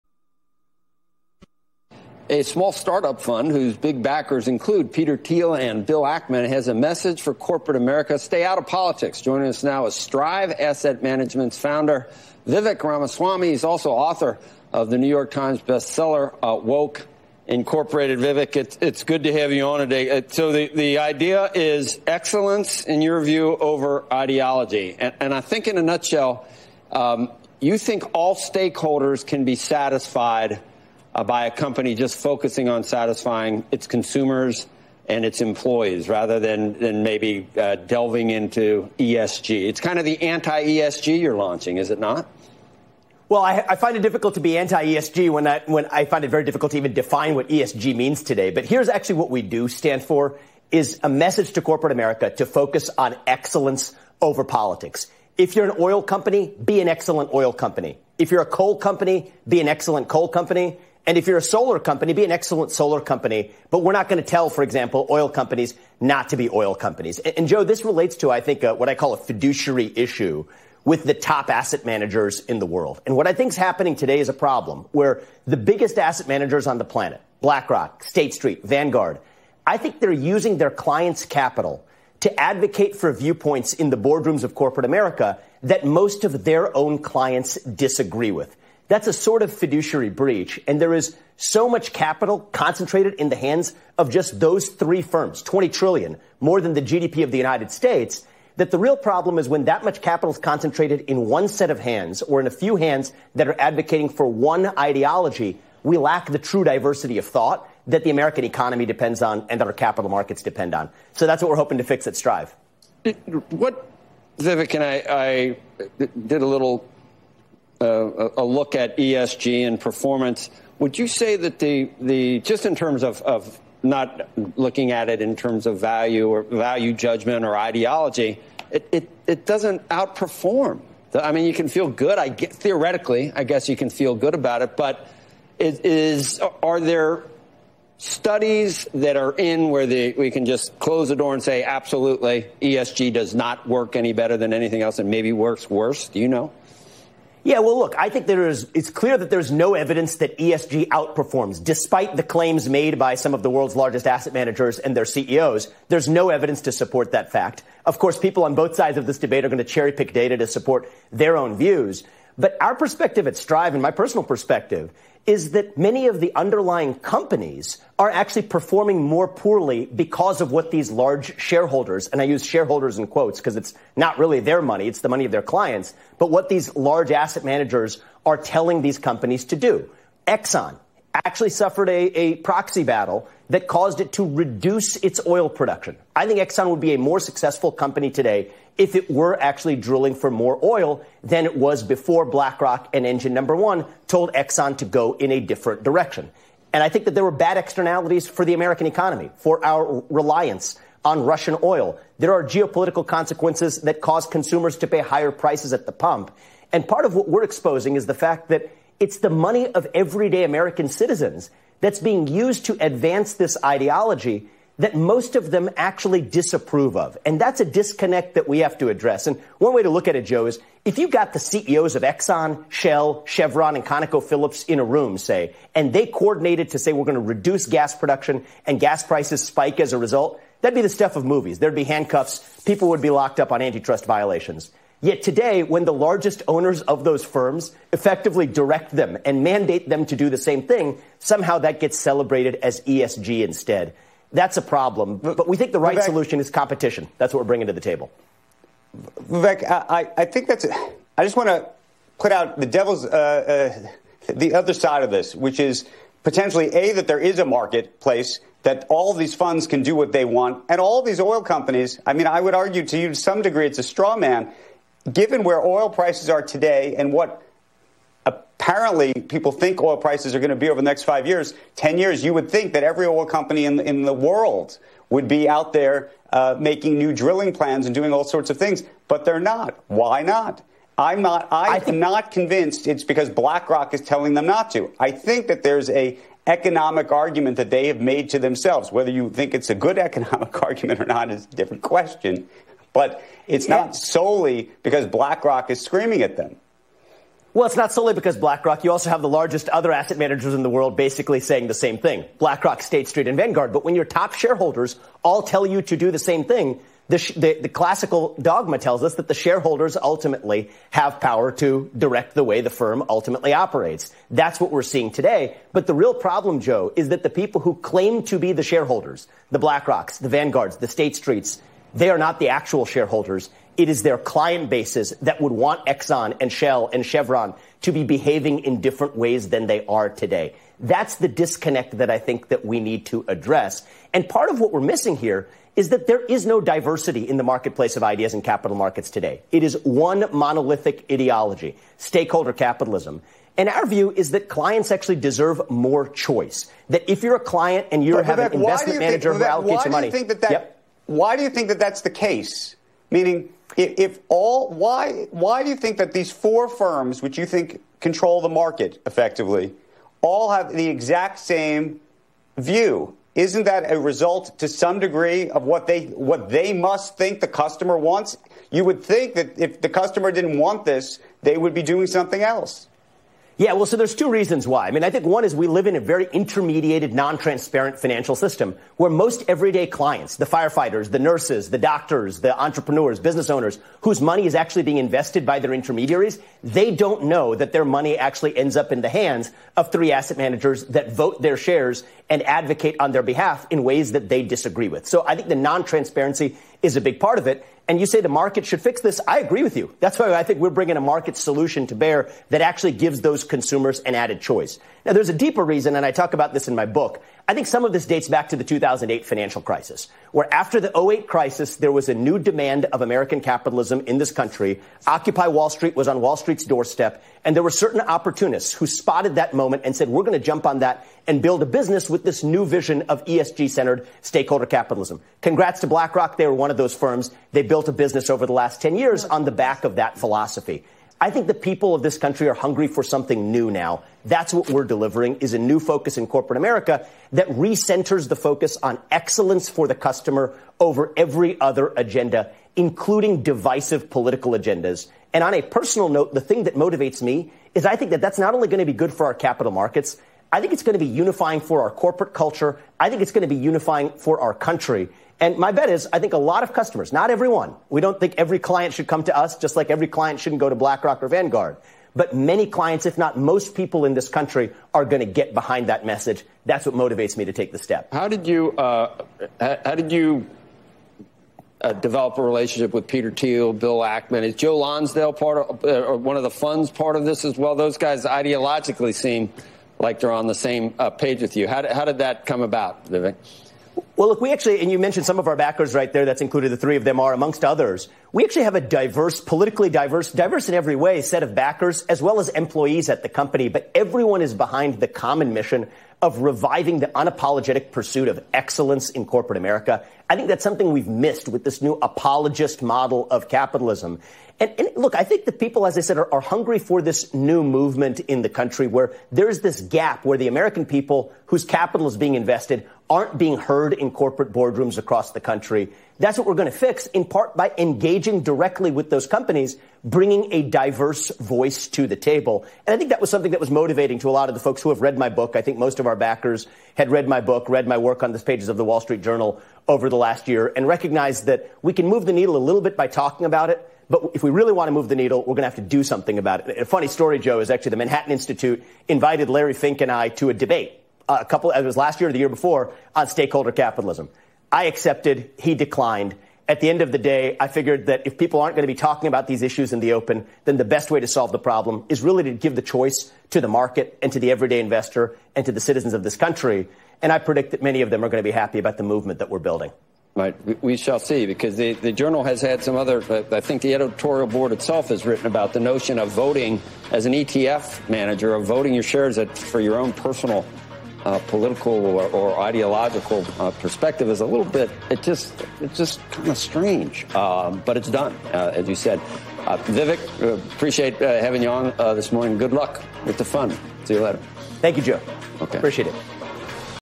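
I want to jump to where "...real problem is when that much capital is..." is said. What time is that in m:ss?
1:38.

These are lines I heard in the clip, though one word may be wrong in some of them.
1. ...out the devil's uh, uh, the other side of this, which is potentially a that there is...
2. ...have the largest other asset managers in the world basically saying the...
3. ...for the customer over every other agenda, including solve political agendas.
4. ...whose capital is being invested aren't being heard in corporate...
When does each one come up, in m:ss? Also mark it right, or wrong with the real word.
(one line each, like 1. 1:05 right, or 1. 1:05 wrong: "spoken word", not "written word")
1. 4:12 right
2. 4:59 right
3. 7:19 wrong: "divisive", not "solve"
4. 8:31 right.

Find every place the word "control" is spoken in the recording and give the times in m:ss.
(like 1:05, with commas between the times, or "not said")
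5:57.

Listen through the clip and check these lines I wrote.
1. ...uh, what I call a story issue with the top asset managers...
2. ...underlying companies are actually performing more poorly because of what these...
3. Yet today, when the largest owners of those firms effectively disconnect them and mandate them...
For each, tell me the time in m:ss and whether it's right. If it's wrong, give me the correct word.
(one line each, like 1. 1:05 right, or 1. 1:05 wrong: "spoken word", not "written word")
1. 1:08 wrong: "fiduciary", not "story"
2. 2:46 right
3. 3:55 wrong: "direct", not "disconnect".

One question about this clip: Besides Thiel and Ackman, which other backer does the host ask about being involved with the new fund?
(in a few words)
Joe Lonsdale.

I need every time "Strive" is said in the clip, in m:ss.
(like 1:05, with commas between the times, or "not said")
0:09, 1:52, 2:43.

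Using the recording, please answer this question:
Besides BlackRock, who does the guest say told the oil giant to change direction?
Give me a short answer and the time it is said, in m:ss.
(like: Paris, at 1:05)
Engine Number One, at 3:13.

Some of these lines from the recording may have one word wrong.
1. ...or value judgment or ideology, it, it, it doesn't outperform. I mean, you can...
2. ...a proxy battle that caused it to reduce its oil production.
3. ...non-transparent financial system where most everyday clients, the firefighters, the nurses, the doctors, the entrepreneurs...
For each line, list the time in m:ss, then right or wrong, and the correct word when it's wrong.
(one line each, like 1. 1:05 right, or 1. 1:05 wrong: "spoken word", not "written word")
1. 2:06 right
2. 3:02 right
3. 6:17 right.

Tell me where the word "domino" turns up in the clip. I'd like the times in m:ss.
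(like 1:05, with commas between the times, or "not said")
not said.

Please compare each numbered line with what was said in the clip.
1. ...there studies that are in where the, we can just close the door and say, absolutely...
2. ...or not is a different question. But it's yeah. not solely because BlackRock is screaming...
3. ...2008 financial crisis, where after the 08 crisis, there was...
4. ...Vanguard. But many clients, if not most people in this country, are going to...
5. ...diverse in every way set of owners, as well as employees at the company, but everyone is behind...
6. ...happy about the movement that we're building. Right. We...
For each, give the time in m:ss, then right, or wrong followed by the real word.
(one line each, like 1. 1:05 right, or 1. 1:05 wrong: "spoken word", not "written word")
1. 2:16 right
2. 4:50 right
3. 6:48 right
4. 7:41 right
5. 8:10 wrong: "backers", not "owners"
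6. 9:18 right.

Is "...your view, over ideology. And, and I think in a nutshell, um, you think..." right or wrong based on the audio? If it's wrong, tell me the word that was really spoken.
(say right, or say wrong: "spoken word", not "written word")
right.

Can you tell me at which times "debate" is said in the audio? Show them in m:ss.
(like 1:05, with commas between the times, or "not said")
2:39, 9:00.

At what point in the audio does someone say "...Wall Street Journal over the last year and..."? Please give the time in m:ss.
8:48.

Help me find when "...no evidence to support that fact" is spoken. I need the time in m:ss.
2:36.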